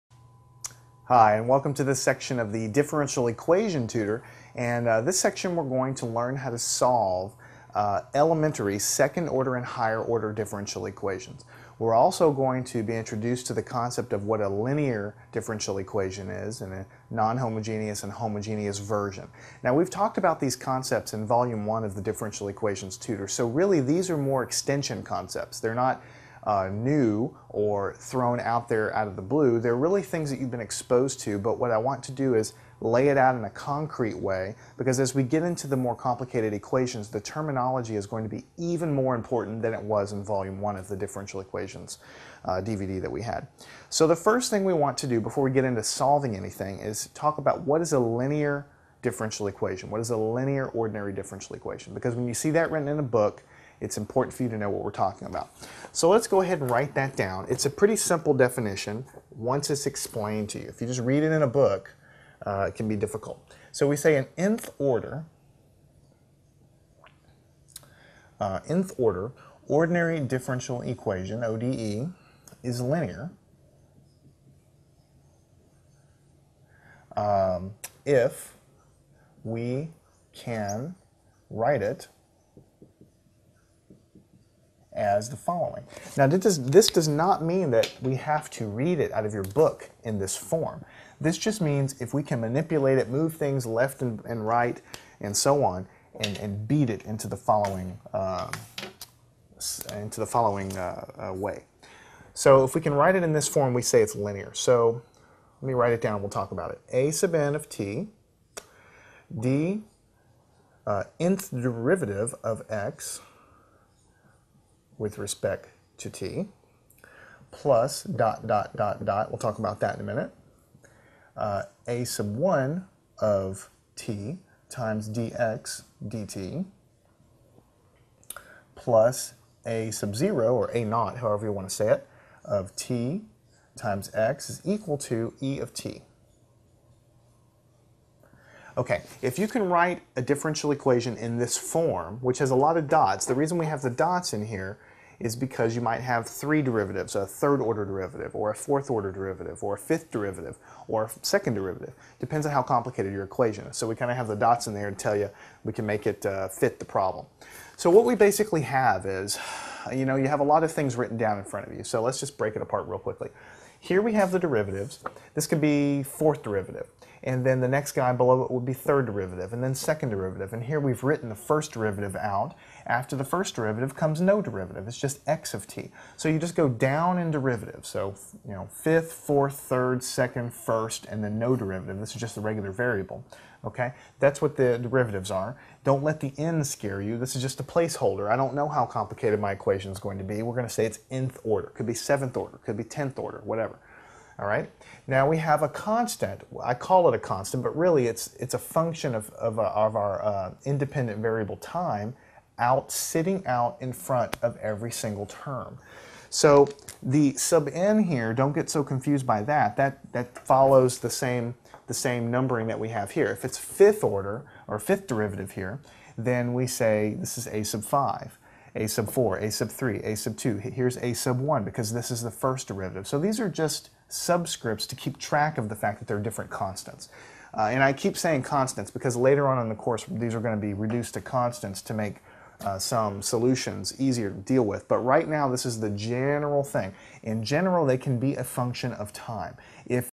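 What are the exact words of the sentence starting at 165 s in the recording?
This could be fourth derivative and then the next guy below it would be third derivative, and then second derivative.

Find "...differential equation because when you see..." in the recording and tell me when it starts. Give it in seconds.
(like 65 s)
51 s.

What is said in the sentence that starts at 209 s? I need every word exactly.
That that follows the same the same numbering that we have here.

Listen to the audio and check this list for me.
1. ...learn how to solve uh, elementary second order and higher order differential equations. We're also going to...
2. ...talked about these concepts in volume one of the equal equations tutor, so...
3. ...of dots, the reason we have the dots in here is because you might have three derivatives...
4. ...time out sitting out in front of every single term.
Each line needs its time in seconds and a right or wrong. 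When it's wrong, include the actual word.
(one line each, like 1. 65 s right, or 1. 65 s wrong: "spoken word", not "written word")
1. 6 s right
2. 19 s wrong: "differential", not "equal"
3. 142 s right
4. 201 s right.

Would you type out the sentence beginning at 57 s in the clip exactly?
It's a pretty simple definition once it's explained to you.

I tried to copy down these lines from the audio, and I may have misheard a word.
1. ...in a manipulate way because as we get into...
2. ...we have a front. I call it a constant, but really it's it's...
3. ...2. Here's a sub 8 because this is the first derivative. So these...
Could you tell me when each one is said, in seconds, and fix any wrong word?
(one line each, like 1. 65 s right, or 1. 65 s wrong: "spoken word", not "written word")
1. 33 s wrong: "concrete", not "manipulate"
2. 195 s wrong: "constant", not "front"
3. 220 s wrong: "1", not "8".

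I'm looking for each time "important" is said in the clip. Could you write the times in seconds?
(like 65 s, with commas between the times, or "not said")
39 s, 53 s.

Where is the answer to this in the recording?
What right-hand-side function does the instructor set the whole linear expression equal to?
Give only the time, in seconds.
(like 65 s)
135 s.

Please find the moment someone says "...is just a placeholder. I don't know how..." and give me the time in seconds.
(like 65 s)
187 s.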